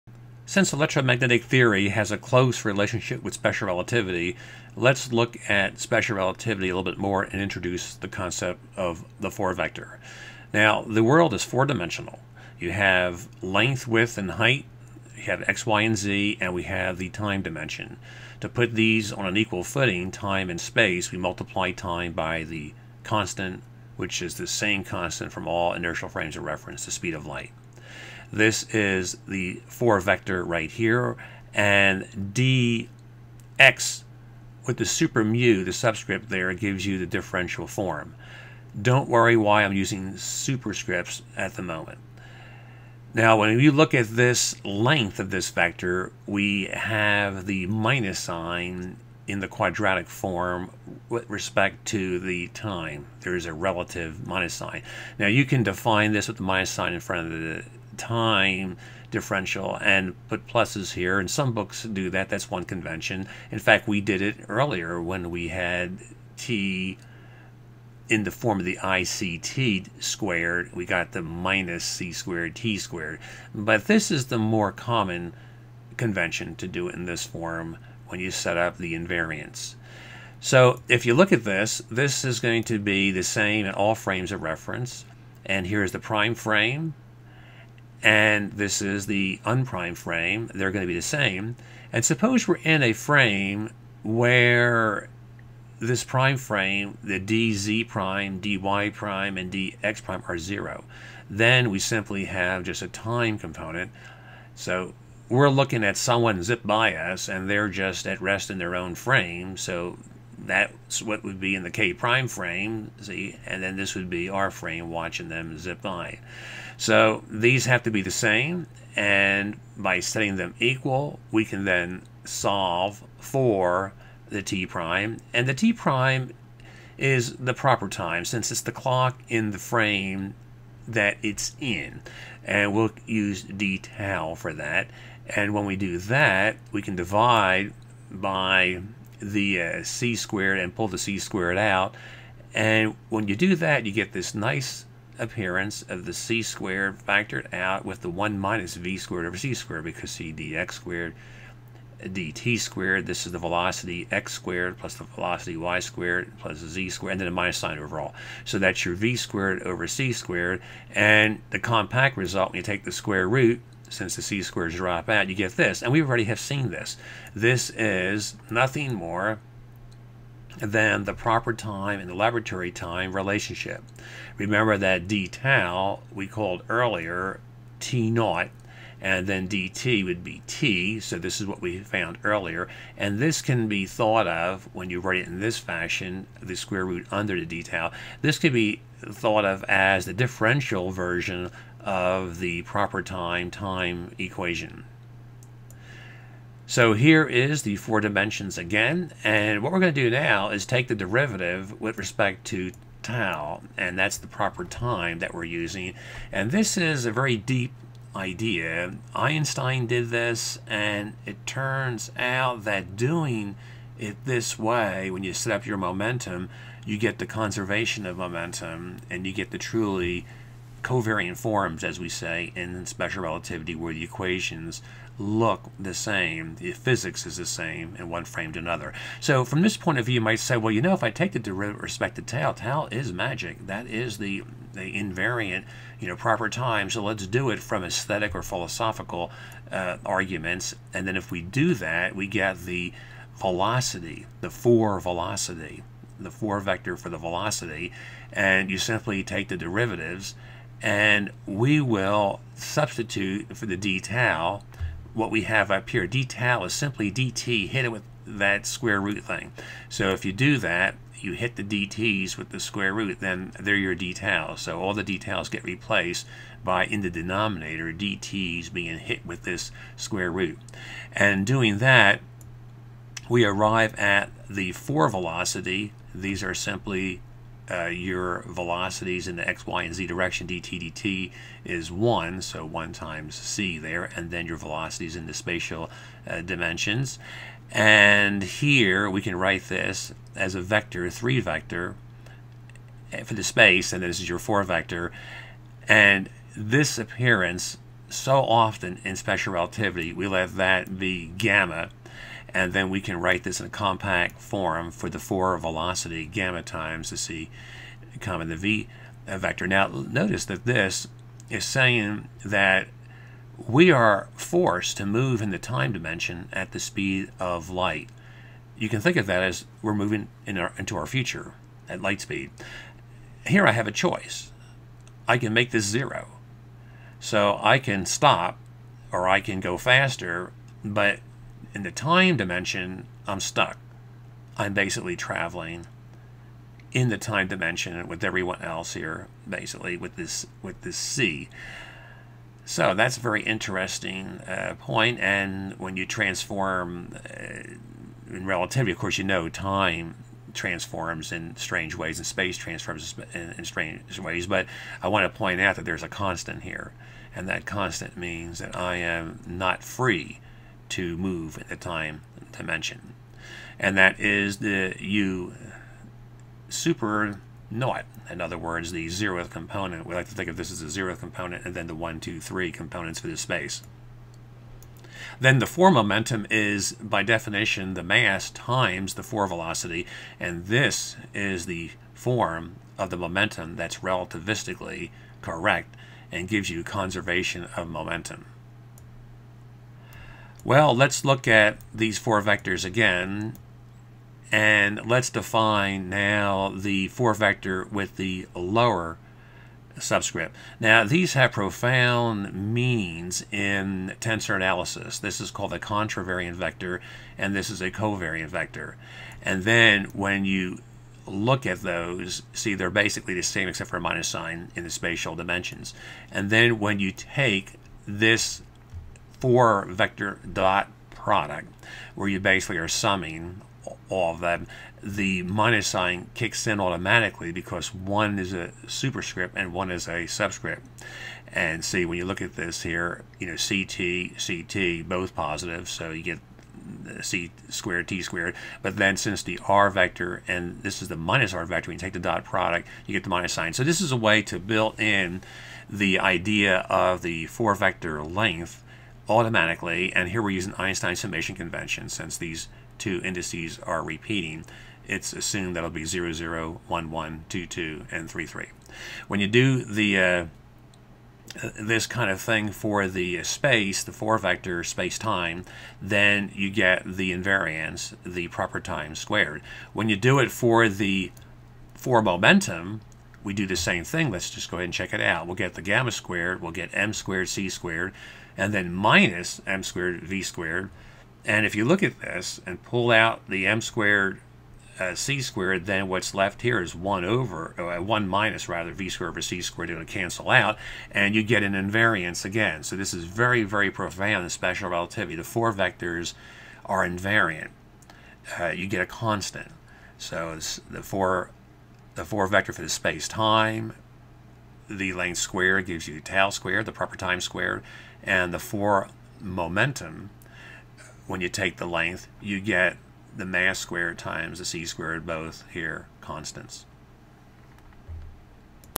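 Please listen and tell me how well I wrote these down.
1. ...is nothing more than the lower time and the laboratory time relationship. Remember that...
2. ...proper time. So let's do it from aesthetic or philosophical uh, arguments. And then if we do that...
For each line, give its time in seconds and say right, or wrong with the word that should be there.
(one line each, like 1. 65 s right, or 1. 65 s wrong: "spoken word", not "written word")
1. 167 s wrong: "proper", not "lower"
2. 236 s right.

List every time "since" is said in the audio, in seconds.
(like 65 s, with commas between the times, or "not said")
0 s, 128 s, 163 s, 439 s, 452 s.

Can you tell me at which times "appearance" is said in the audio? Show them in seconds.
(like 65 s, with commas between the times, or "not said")
145 s, 296 s.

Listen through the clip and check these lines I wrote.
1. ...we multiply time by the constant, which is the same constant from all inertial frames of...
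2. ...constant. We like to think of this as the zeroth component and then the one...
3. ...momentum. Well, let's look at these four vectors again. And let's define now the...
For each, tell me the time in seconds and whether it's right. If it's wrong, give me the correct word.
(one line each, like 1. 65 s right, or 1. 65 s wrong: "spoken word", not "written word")
1. 21 s right
2. 369 s wrong: "component", not "constant"
3. 387 s right.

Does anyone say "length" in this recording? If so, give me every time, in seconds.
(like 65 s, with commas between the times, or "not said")
13 s, 44 s, 448 s, 505 s, 511 s.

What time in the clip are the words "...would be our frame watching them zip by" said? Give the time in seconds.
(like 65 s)
113 s.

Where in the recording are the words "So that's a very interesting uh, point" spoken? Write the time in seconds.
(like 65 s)
342 s.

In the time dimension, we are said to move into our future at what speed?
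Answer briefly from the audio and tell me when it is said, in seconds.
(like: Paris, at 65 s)
light speed, at 322 s.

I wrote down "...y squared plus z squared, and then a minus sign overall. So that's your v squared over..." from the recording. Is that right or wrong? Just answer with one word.
right.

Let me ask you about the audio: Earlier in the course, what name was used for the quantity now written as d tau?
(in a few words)
t naught.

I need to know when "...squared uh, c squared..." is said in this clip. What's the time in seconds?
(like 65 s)
483 s.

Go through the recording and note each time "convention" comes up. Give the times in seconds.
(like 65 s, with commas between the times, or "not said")
62 s, 75 s, 451 s.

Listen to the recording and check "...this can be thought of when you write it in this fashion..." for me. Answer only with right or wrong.
right.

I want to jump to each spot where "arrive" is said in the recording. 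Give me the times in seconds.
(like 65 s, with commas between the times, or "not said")
273 s.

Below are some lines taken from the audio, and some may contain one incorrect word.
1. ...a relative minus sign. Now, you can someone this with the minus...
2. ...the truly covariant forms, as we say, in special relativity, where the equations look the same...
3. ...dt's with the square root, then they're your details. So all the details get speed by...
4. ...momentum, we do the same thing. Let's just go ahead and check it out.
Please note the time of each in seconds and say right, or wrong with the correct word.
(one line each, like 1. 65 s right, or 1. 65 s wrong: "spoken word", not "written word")
1. 53 s wrong: "define", not "someone"
2. 219 s right
3. 261 s wrong: "replaced", not "speed"
4. 472 s right.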